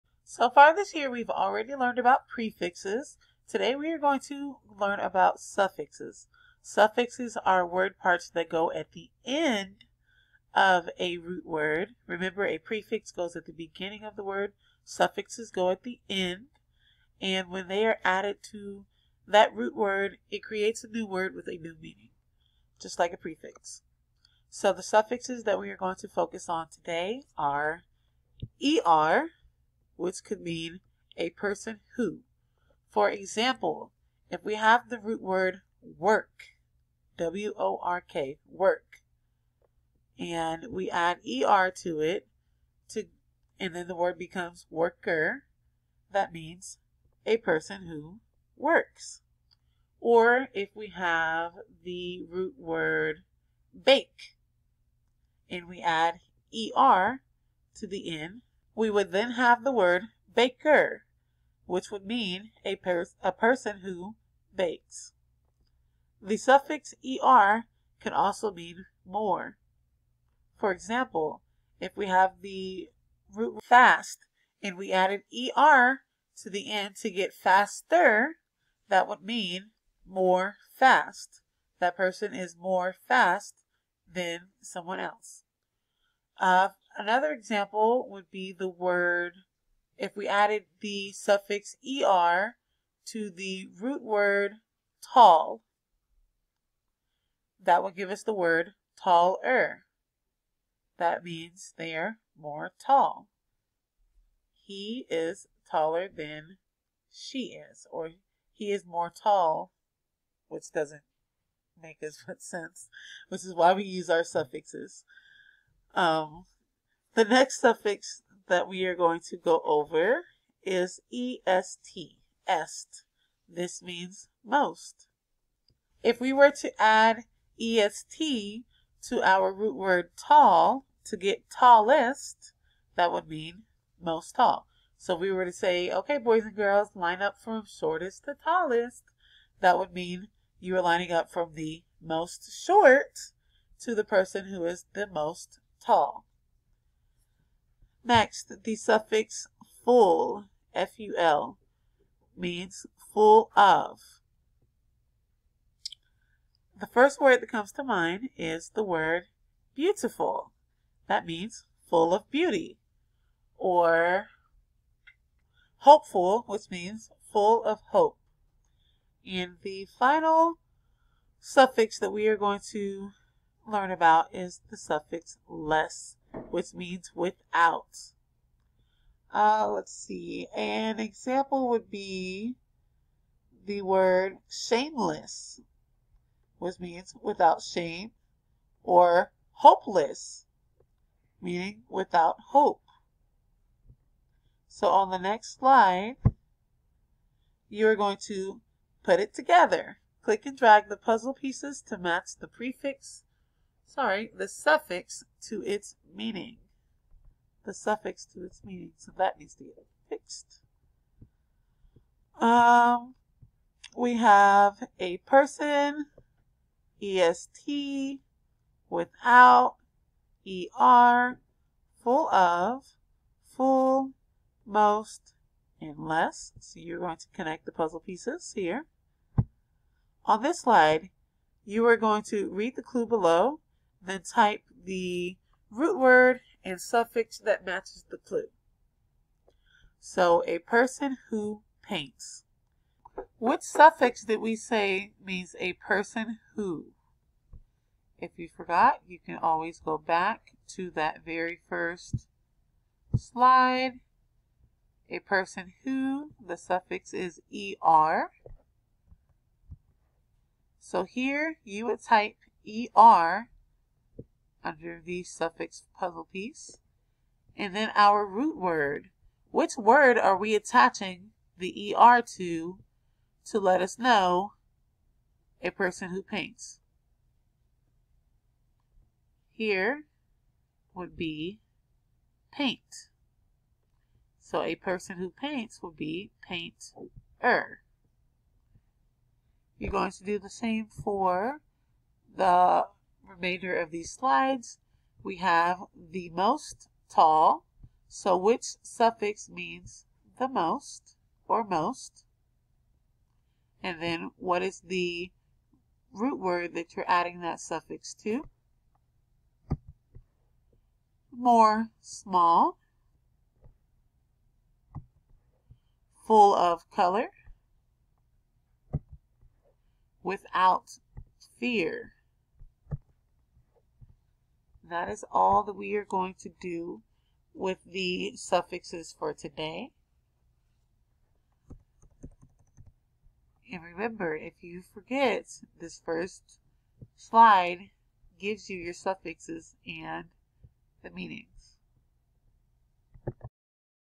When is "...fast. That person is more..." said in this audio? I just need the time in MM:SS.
01:20.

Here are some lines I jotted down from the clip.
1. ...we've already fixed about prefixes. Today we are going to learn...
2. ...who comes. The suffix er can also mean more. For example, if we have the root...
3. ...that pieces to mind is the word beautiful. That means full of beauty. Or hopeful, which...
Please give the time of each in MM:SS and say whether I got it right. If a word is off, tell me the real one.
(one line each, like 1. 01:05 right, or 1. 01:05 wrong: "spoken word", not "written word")
1. 00:01 wrong: "learned", not "fixed"
2. 01:03 wrong: "bakes", not "comes"
3. 02:37 wrong: "comes", not "pieces".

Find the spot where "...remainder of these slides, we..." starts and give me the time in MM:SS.
04:53.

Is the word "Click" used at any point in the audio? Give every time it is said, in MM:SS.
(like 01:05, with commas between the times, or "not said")
03:20.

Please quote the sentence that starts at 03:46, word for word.
So you're going to connect the puzzle pieces here.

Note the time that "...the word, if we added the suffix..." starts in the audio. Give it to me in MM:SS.
01:28.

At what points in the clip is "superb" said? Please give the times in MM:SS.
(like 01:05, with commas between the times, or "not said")
not said.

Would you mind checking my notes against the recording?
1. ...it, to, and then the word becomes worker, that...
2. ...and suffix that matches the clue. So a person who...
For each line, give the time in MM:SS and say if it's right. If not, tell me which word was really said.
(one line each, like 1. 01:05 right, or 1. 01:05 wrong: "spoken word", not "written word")
1. 00:41 right
2. 03:56 right.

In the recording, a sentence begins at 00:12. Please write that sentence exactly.
Remember, a prefix goes at the beginning of the word.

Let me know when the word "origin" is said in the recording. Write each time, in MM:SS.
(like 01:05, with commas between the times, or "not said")
not said.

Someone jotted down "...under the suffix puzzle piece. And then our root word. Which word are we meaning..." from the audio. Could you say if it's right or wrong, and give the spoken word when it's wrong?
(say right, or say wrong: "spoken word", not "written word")
wrong: "attaching", not "meaning".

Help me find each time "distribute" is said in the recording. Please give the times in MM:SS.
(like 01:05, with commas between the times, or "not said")
not said.